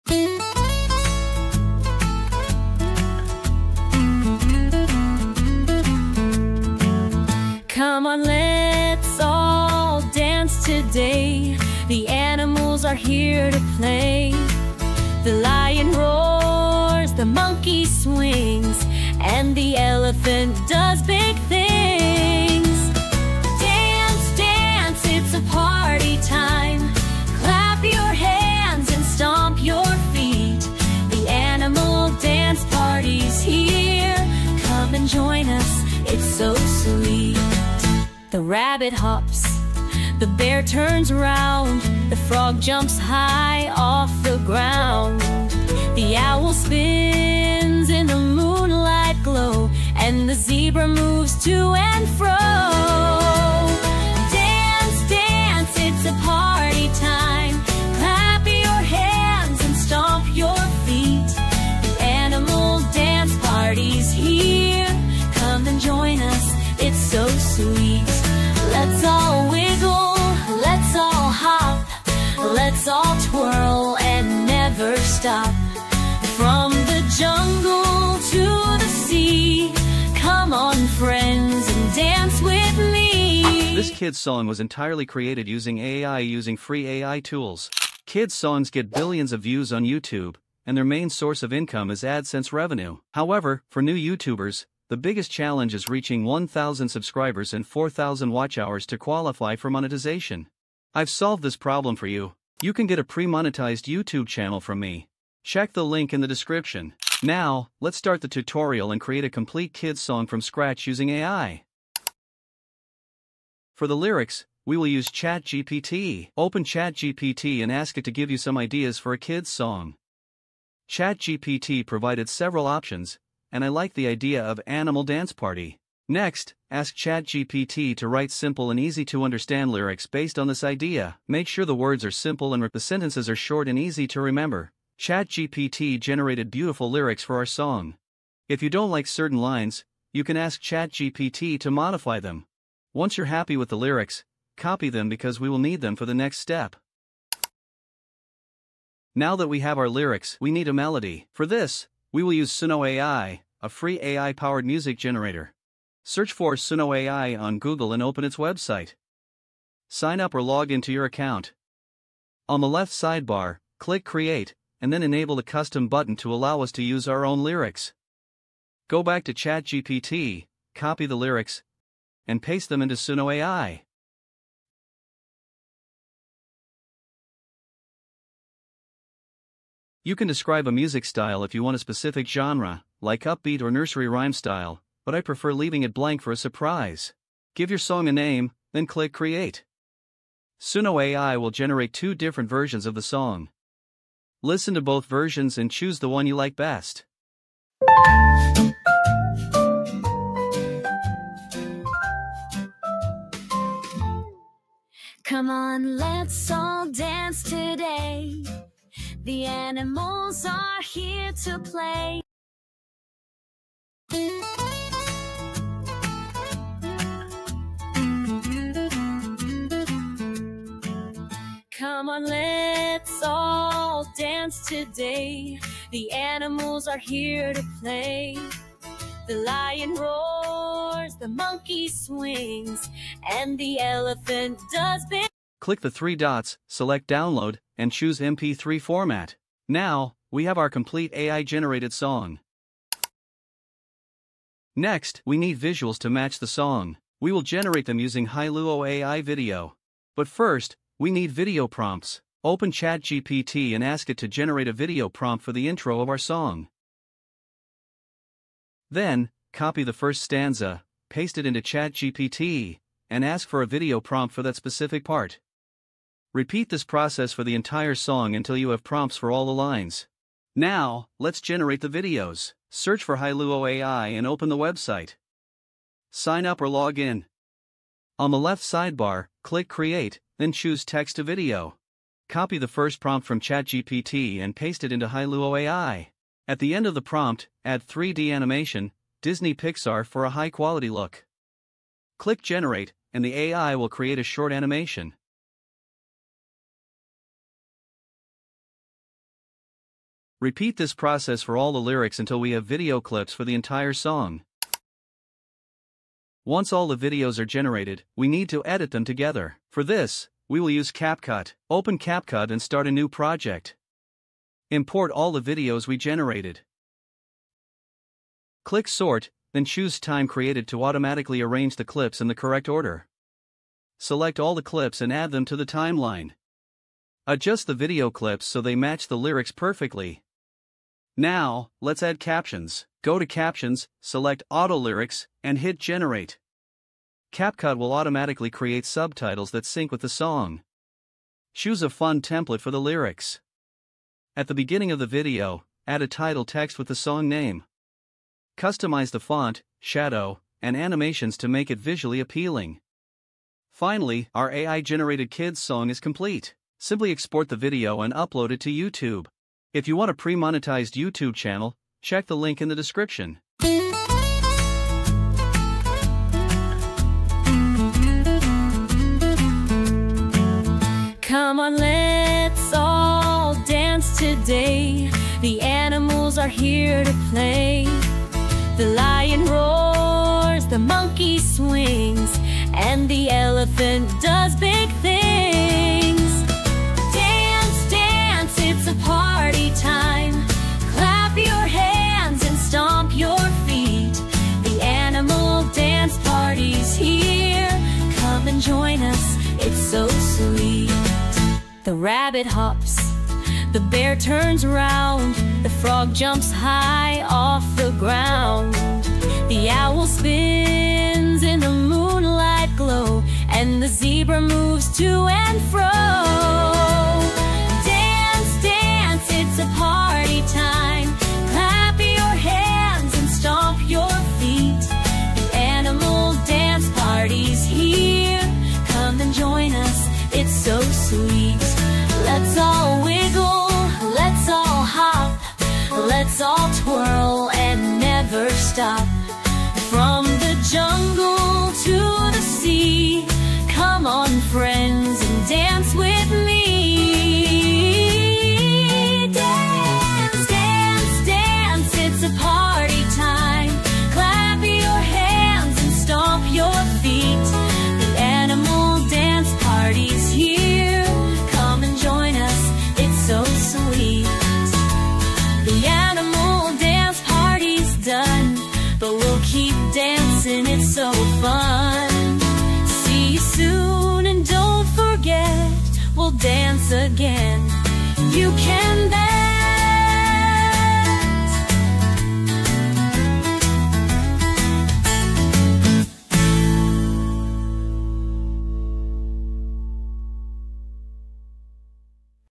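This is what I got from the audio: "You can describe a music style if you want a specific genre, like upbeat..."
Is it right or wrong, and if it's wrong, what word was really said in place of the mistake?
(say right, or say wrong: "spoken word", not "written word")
right.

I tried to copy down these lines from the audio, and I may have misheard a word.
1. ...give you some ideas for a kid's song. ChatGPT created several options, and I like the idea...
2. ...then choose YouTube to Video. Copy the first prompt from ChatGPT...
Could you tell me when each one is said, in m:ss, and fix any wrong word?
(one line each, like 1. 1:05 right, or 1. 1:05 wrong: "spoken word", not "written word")
1. 1:58 wrong: "provided", not "created"
2. 4:40 wrong: "Text", not "YouTube".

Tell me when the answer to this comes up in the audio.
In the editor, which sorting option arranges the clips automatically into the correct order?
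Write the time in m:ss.
5:19.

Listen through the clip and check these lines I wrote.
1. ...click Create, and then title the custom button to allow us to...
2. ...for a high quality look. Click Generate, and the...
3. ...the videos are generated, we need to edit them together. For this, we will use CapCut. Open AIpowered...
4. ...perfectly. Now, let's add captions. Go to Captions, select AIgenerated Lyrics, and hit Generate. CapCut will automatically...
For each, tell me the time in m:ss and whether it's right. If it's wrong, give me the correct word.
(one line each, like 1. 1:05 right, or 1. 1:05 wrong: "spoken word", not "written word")
1. 2:43 wrong: "enable", not "title"
2. 4:50 right
3. 5:06 wrong: "CapCut", not "AIpowered"
4. 5:29 wrong: "Auto", not "AIgenerated".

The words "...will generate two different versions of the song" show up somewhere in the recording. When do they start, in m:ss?
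3:11.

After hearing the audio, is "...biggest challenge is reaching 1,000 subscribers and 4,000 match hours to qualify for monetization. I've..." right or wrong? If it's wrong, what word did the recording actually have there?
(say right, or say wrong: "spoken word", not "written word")
wrong: "watch", not "match".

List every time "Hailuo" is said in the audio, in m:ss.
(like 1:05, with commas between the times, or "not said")
4:08, 4:33, 4:45.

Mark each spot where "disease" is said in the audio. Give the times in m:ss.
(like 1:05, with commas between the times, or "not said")
not said.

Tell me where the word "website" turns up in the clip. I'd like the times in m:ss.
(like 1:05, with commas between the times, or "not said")
2:38, 4:34.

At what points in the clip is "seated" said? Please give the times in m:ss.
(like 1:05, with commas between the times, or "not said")
not said.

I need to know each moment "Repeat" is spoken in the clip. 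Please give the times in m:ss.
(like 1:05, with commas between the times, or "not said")
4:26, 5:00.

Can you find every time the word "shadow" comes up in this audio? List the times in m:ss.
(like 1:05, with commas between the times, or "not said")
5:49.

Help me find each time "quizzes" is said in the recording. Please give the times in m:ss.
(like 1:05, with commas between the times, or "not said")
not said.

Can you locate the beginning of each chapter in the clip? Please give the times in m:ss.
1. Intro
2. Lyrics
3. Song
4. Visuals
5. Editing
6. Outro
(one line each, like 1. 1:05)
1. 1:23
2. 1:52
3. 2:27
4. 4:03
5. 5:04
6. 6:03.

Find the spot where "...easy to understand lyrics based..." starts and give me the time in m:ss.
2:08.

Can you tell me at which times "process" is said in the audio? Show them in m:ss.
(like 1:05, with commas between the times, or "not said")
4:26, 5:00.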